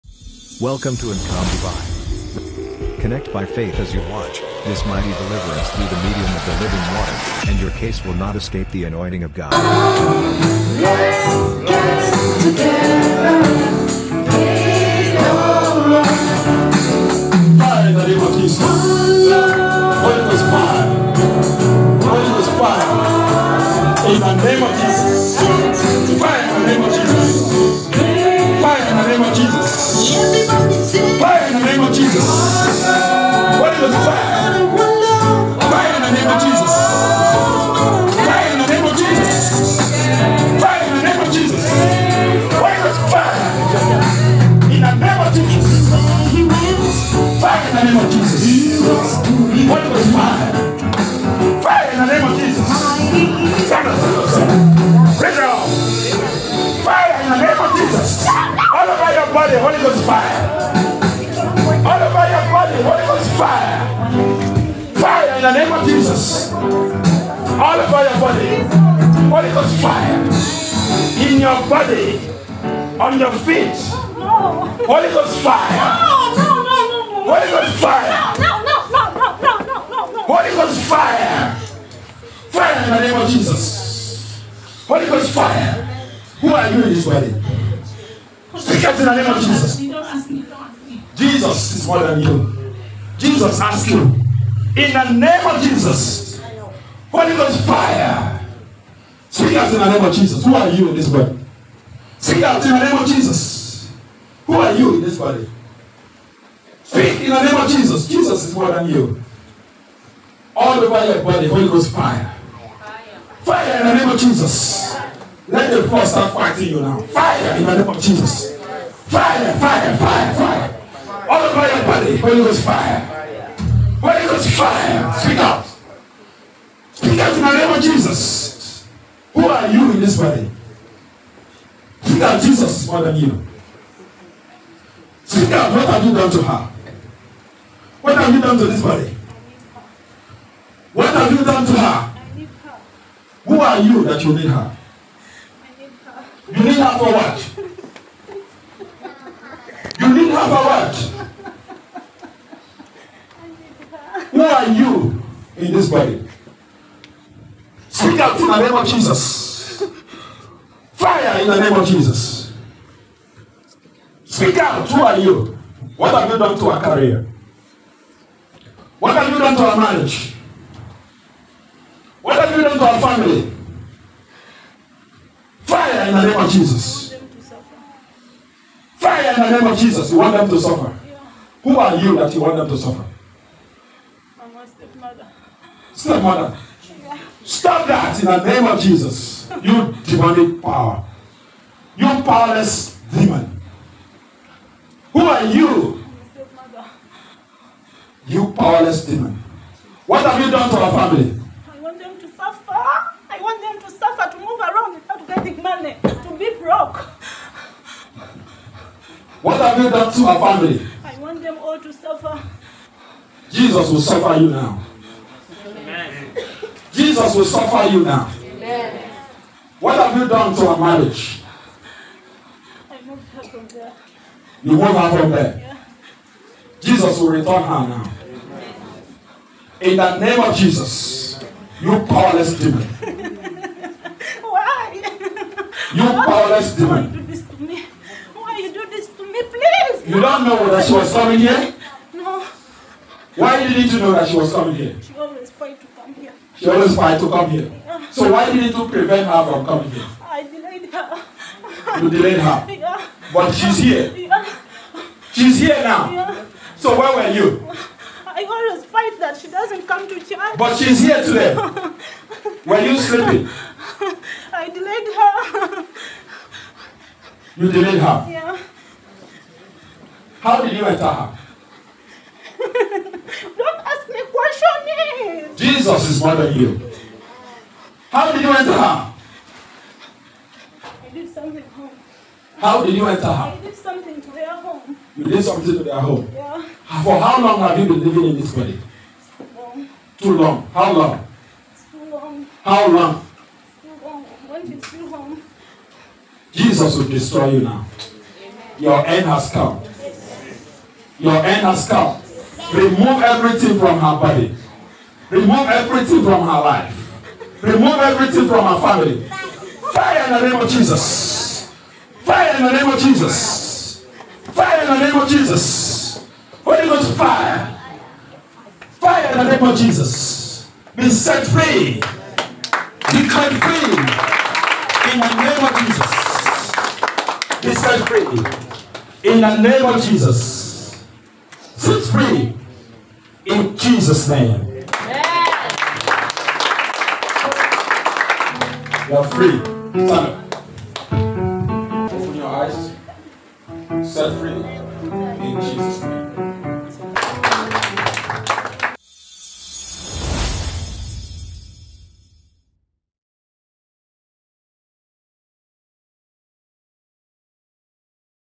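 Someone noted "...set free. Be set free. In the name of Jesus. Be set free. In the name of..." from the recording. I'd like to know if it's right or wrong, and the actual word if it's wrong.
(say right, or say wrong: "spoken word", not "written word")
right.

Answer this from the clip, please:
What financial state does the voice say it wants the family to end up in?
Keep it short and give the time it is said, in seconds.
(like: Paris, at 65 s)
Broke, at 206 s.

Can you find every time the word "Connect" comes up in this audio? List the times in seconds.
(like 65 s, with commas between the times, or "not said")
3 s.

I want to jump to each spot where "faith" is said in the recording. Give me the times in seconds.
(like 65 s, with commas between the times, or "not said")
3 s.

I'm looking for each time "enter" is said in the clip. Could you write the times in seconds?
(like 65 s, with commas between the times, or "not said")
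270 s, 278 s, 283 s.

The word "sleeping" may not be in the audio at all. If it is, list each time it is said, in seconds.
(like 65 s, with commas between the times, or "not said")
262 s.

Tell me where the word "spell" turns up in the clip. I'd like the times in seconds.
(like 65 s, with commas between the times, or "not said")
not said.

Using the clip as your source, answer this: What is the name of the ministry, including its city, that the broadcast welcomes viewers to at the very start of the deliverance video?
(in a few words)
AGCOM Dubai.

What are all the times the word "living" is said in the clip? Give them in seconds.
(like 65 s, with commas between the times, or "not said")
6 s, 288 s.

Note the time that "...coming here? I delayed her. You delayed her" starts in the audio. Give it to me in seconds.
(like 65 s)
249 s.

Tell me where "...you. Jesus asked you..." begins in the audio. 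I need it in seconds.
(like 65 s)
92 s.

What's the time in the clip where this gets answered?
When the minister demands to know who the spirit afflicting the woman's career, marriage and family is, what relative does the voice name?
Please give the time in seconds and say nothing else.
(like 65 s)
184 s.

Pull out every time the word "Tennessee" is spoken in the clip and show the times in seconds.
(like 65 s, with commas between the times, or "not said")
not said.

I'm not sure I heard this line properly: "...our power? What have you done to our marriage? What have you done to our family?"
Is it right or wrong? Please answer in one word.
wrong.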